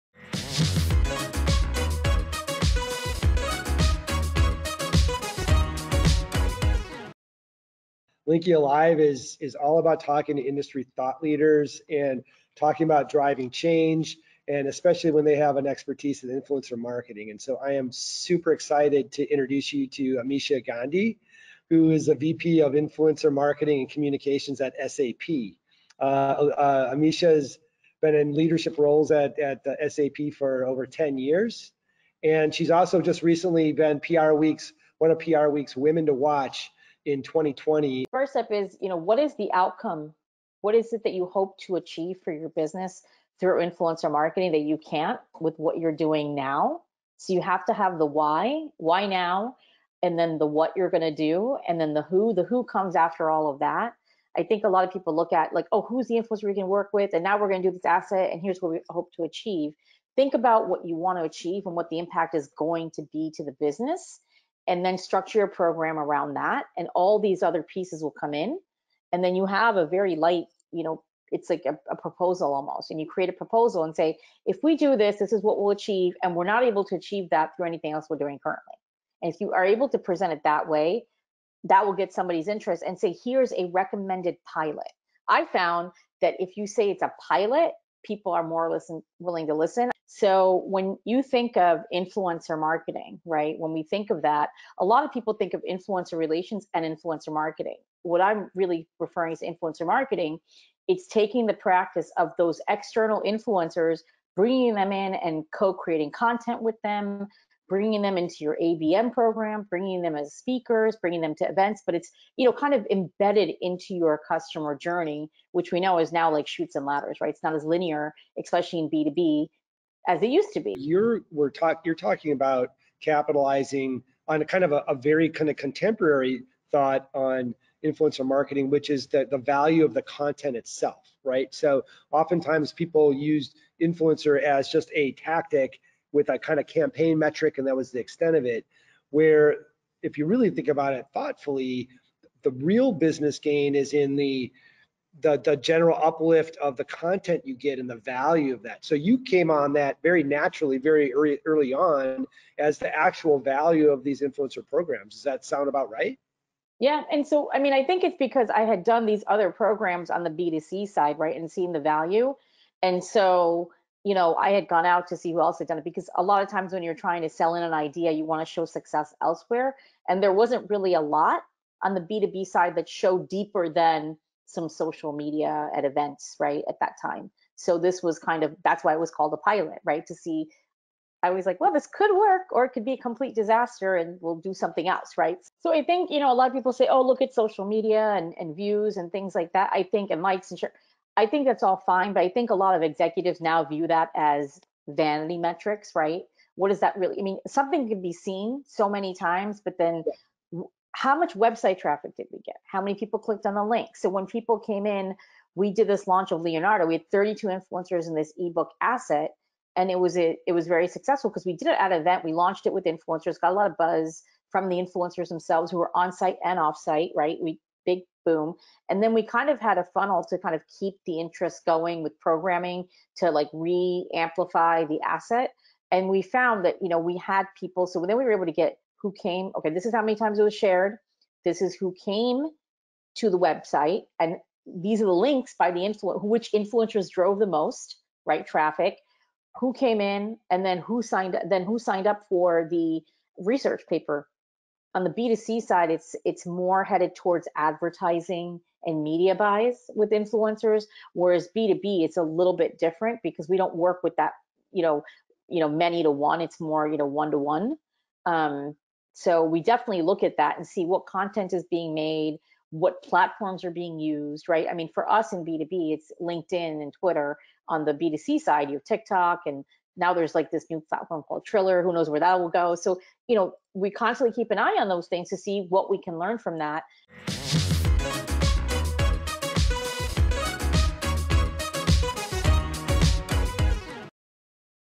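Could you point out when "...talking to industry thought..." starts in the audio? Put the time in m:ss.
0:09.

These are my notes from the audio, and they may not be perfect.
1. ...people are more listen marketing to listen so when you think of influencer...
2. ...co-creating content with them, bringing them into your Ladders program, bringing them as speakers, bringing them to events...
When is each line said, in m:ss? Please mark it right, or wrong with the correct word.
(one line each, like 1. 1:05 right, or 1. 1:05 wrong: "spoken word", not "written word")
1. 1:28 wrong: "willing", not "marketing"
2. 1:45 wrong: "ABM", not "Ladders".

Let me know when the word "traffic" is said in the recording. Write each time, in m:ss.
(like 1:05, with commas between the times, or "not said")
3:21, 3:58.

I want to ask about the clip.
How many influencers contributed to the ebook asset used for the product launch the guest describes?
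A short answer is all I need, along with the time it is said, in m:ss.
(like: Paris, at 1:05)
32, at 3:27.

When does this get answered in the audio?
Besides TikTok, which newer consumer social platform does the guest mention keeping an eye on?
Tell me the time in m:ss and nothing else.
4:31.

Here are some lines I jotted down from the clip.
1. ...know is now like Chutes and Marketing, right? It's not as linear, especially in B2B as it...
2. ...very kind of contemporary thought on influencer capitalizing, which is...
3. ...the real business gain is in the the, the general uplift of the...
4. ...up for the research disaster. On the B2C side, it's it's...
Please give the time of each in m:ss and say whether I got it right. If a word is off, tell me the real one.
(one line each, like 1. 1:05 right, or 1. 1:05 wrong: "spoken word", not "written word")
1. 1:55 wrong: "Ladders", not "Marketing"
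2. 2:04 wrong: "marketing", not "capitalizing"
3. 2:22 right
4. 4:02 wrong: "paper", not "disaster".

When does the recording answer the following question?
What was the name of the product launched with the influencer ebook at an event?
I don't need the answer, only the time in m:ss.
3:26.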